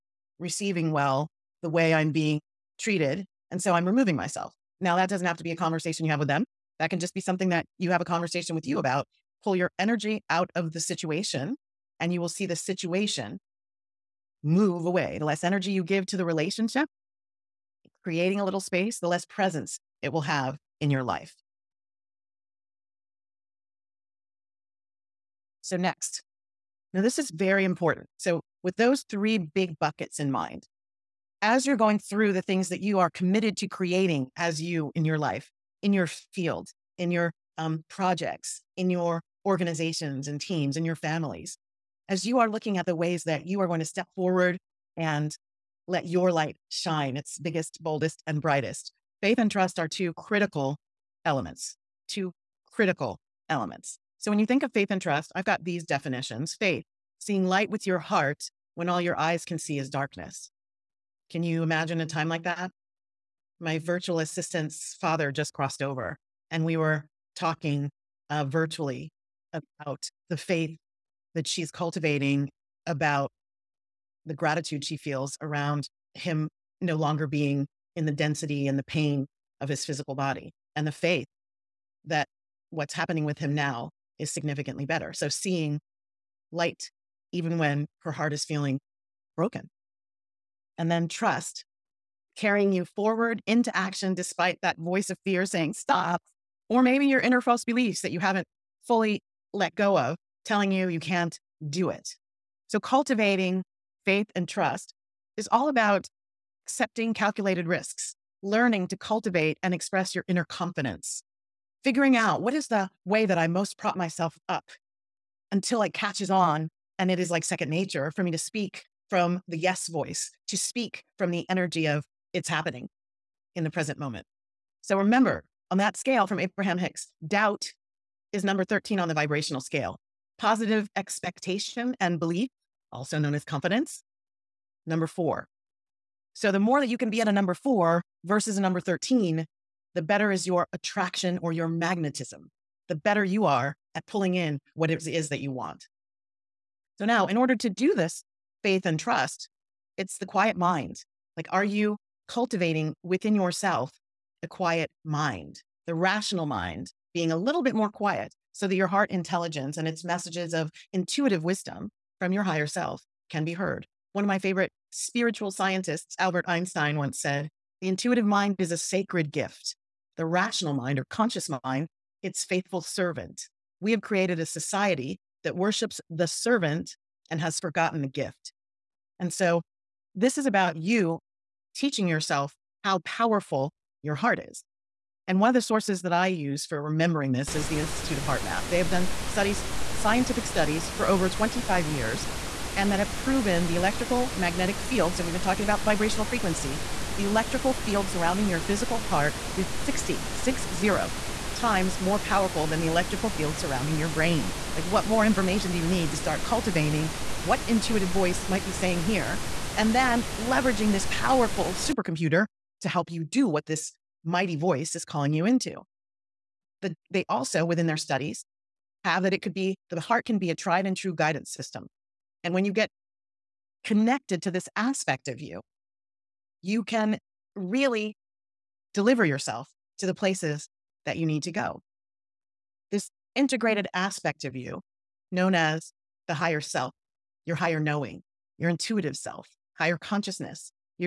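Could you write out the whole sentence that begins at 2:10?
Positive expectation and belief, also known as confidence, number four.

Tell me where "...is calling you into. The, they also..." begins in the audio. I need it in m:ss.
3:34.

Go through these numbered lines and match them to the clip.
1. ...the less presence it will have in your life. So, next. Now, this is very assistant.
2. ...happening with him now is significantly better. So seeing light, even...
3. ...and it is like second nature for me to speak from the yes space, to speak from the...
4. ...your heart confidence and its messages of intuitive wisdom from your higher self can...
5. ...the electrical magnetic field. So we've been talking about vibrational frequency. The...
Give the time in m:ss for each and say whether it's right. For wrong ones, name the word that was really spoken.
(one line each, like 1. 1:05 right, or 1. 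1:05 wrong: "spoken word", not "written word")
1. 0:18 wrong: "important", not "assistant"
2. 1:22 right
3. 1:57 wrong: "voice", not "space"
4. 2:38 wrong: "intelligence", not "confidence"
5. 3:13 right.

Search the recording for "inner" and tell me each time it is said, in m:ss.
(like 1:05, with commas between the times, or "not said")
1:37, 1:50.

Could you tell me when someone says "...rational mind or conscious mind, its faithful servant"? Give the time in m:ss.
2:50.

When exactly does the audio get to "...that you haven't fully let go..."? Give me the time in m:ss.
1:38.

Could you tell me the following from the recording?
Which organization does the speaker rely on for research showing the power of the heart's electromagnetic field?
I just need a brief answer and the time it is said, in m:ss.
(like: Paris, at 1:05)
Institute of HeartMath, at 3:07.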